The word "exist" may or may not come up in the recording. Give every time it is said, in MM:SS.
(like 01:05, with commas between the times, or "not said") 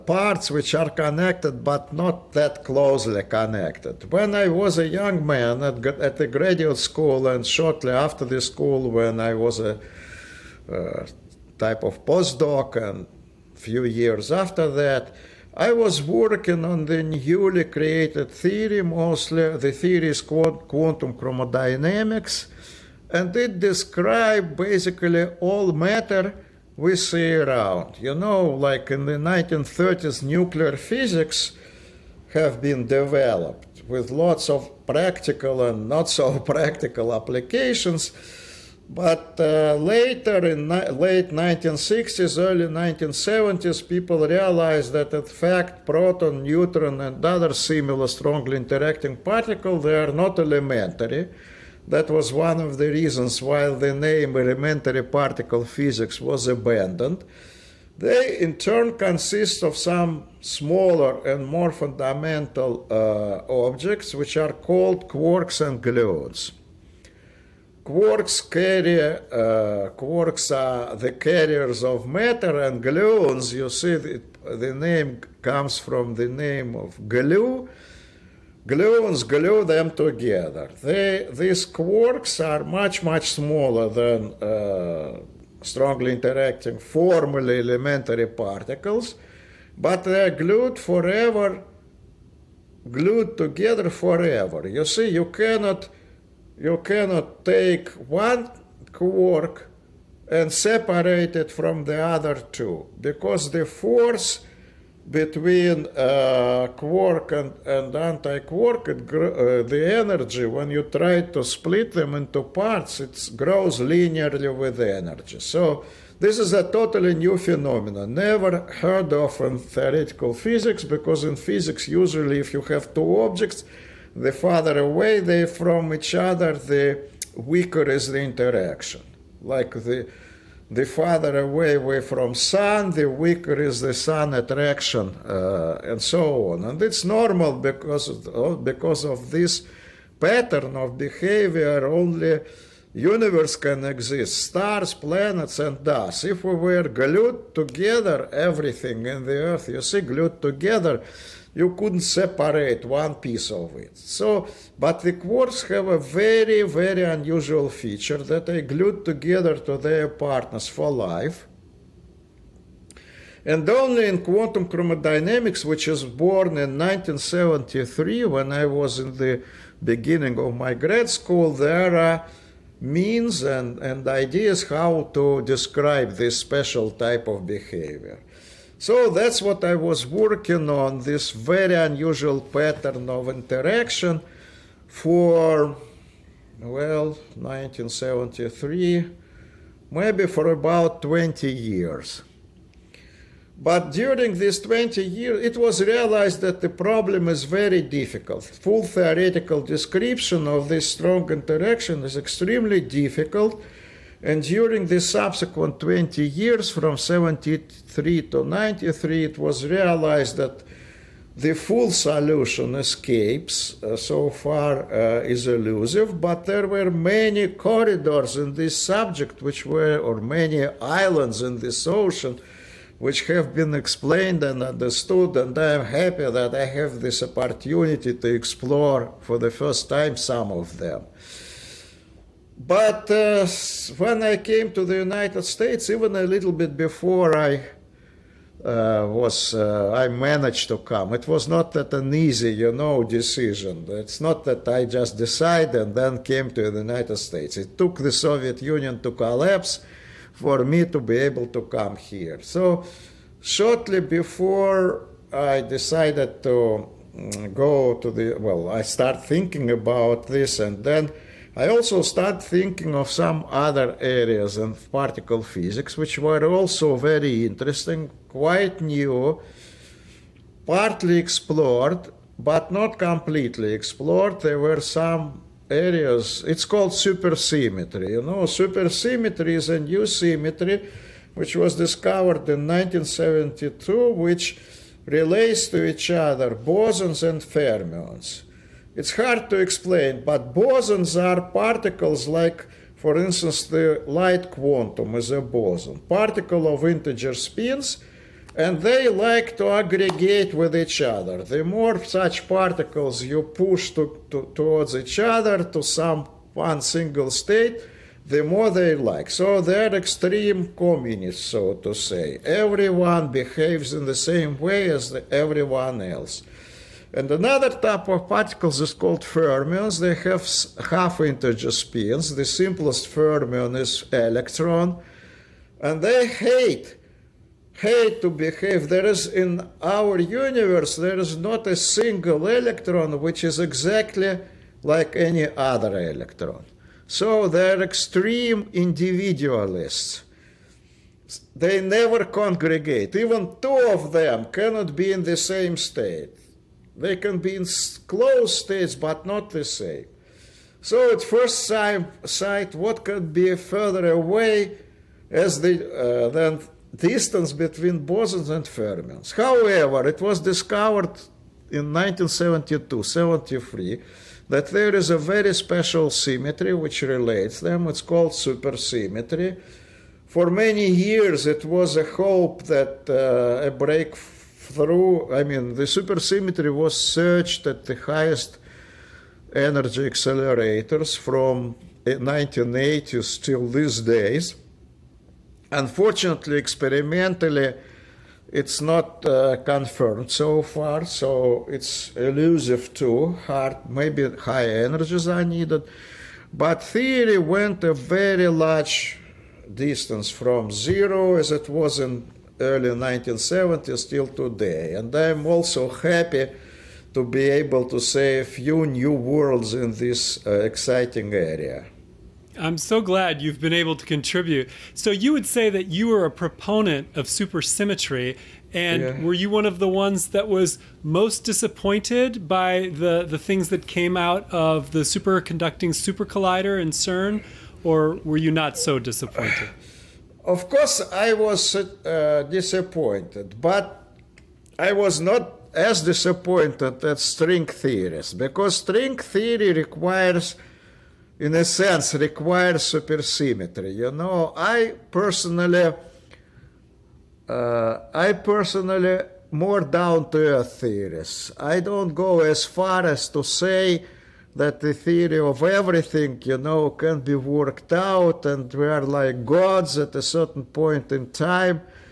02:23.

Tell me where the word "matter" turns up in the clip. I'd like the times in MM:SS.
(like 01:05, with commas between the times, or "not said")
00:25, 01:12.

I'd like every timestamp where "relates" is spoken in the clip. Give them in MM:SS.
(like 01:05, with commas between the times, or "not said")
04:45, 06:07.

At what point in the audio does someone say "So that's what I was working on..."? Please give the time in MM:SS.
02:58.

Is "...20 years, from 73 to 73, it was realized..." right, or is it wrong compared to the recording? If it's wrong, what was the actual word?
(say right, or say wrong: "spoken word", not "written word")
wrong: "93", not "73".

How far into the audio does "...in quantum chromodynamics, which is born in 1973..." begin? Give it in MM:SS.
02:44.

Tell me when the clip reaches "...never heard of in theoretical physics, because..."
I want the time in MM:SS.
01:58.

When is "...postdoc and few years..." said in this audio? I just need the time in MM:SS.
00:12.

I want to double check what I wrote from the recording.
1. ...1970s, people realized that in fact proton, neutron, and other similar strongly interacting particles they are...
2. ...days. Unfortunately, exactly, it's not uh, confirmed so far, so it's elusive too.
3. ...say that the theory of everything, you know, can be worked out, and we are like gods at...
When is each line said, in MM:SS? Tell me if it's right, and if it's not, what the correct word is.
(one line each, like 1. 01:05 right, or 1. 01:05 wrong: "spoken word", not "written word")
1. 00:42 right
2. 06:24 wrong: "experimentally", not "exactly"
3. 07:33 right.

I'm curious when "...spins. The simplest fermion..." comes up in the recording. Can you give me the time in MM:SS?
05:21.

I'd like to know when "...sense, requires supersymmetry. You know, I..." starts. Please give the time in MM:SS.
07:21.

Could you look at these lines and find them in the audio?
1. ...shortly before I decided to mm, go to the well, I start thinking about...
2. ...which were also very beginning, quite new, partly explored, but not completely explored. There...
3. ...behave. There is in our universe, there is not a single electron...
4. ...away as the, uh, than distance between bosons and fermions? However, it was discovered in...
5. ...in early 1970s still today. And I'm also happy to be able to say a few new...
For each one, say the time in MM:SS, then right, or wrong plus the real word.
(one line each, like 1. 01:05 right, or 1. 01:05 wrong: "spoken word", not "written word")
1. 04:13 right
2. 04:25 wrong: "interesting", not "beginning"
3. 05:28 right
4. 05:54 right
5. 06:41 right.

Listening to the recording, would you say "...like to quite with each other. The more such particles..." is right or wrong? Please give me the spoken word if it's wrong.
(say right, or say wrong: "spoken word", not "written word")
wrong: "aggregate", not "quite".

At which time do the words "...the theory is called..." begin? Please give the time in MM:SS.
00:19.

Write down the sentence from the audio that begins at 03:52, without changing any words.
But uh, when I came to the United States, even a little bit before I uh, was, uh, I managed to come.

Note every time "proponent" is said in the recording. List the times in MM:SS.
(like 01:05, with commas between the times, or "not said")
06:56.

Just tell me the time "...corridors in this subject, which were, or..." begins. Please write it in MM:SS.
03:37.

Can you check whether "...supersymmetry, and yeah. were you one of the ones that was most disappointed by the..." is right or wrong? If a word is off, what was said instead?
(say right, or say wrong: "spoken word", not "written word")
right.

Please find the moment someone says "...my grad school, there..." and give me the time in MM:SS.
02:50.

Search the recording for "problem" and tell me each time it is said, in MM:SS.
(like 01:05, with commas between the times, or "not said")
03:16.